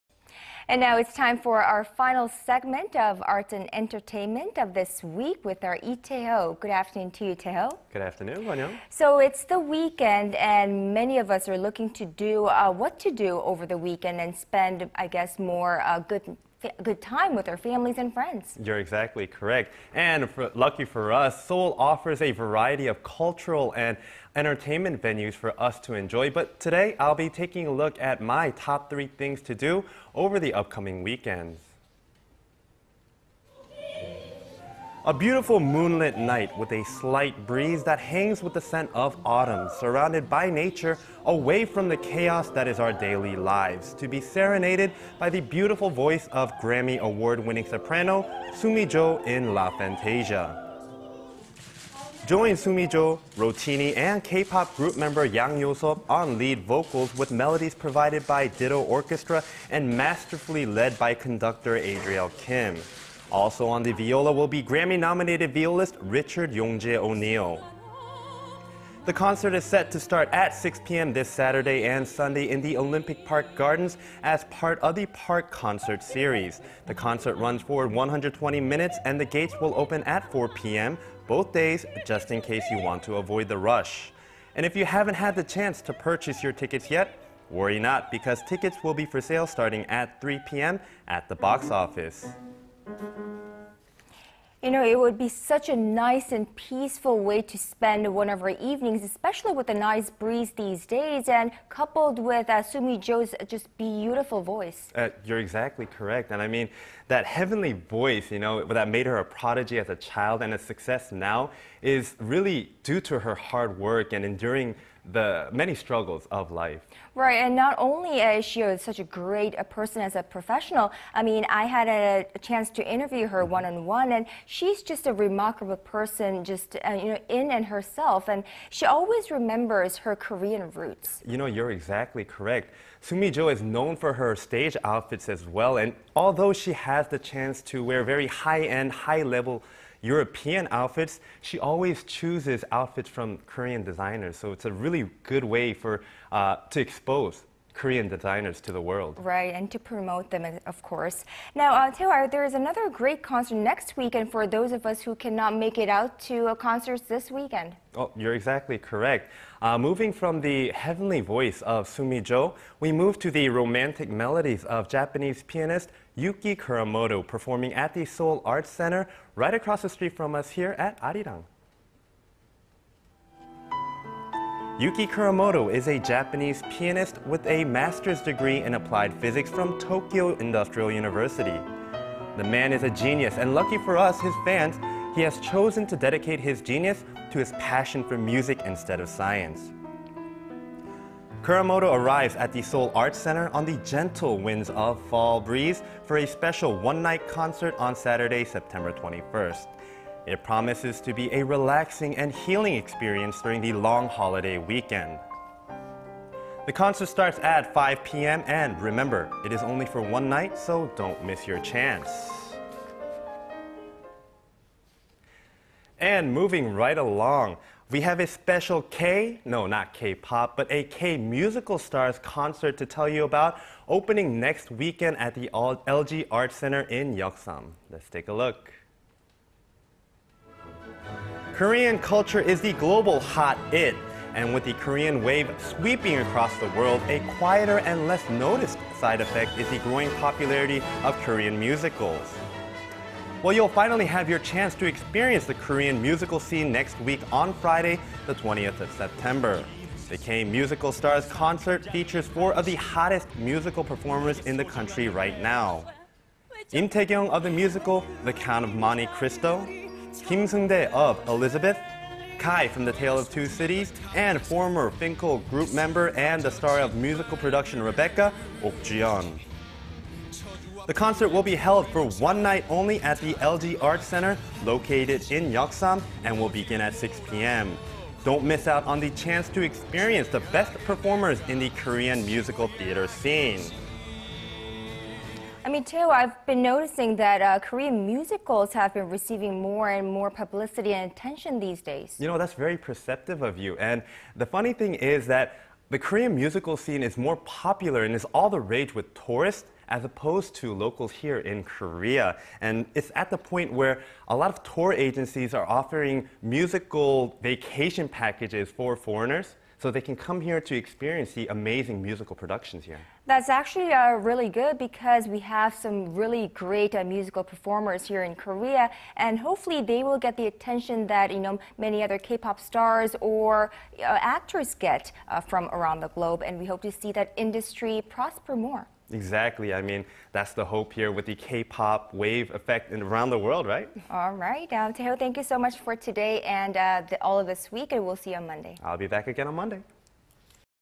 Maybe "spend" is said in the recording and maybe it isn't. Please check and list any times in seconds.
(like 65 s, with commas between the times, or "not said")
14 s, 97 s.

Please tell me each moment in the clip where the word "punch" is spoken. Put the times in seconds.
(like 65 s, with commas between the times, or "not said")
not said.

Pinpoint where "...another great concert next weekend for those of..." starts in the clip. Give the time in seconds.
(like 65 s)
152 s.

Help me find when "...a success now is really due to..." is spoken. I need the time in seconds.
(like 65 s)
110 s.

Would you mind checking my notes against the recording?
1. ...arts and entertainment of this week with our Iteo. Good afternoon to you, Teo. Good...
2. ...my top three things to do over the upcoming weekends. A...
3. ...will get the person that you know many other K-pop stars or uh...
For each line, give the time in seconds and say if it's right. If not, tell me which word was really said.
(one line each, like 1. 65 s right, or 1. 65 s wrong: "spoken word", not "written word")
1. 3 s right
2. 28 s right
3. 320 s wrong: "attention", not "person".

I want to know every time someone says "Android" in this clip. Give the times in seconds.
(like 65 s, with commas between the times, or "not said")
not said.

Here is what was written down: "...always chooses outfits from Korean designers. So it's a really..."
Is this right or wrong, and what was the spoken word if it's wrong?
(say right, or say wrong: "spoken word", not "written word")
right.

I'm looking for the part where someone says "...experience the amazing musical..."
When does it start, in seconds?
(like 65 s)
310 s.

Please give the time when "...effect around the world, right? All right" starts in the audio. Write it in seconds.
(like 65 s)
332 s.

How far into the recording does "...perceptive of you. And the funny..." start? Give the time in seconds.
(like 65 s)
292 s.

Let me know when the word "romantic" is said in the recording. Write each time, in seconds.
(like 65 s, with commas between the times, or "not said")
163 s.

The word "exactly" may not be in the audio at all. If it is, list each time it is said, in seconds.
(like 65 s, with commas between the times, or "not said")
18 s, 105 s, 131 s, 158 s, 329 s.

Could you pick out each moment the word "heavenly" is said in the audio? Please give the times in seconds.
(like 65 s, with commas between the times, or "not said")
107 s, 160 s.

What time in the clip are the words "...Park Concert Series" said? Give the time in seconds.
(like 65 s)
75 s.